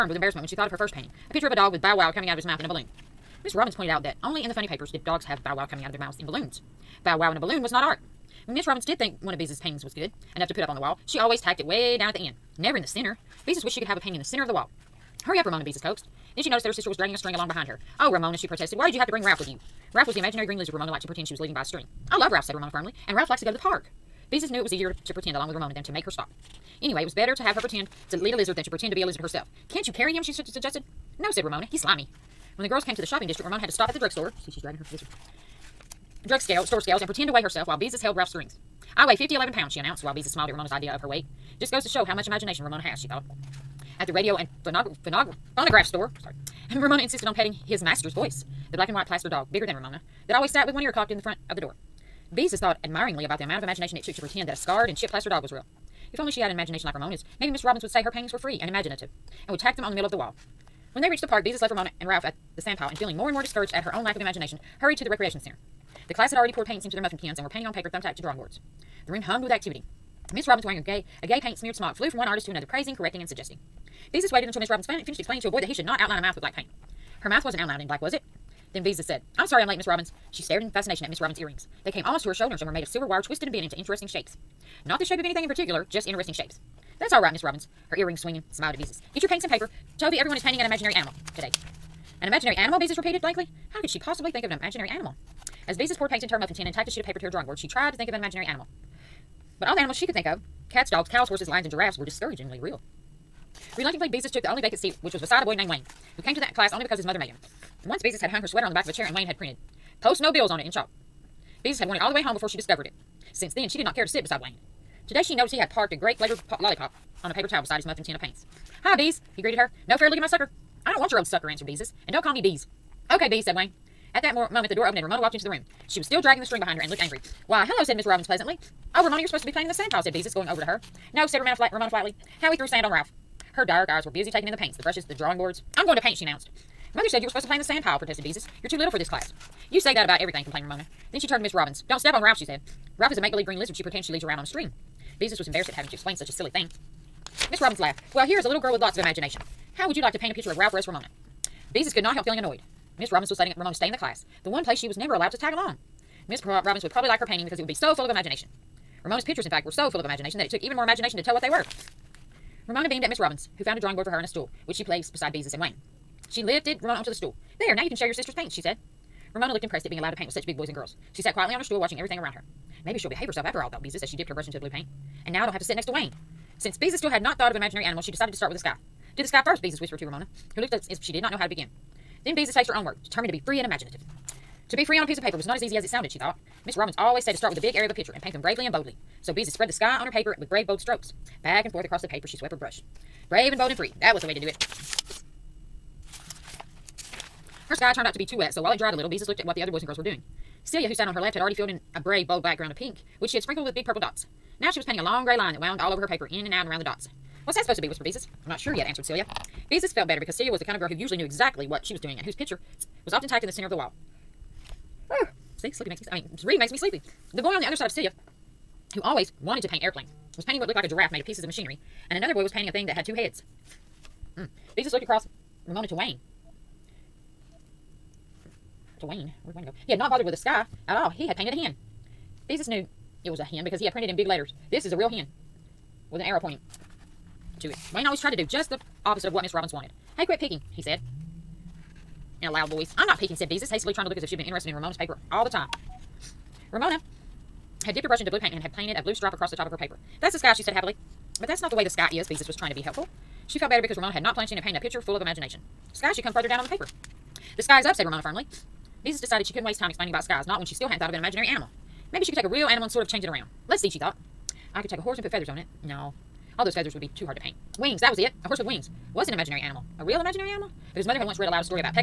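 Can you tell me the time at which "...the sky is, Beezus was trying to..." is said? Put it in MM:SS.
04:11.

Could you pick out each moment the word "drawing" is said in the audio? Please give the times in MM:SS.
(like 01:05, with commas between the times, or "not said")
01:08, 01:37, 02:15, 02:43.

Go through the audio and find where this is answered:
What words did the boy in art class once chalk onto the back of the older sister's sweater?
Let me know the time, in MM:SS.
01:49.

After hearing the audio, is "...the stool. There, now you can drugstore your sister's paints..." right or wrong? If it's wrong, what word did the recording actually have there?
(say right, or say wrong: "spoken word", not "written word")
wrong: "share", not "drugstore".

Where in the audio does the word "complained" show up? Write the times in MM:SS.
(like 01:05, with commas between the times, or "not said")
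02:20.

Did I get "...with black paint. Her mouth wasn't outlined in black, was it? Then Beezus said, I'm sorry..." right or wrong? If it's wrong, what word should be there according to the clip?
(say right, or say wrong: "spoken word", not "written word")
right.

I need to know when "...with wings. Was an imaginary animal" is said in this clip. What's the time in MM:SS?
04:28.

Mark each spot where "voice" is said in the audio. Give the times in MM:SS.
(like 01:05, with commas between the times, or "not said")
00:48, 04:02.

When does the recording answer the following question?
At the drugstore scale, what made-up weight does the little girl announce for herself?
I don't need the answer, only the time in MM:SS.
00:39.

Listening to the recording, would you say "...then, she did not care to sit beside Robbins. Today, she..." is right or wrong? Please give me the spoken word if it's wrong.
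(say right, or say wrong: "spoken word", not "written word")
wrong: "Wayne", not "Robbins".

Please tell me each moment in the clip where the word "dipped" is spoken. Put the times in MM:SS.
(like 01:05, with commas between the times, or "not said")
02:54, 04:07.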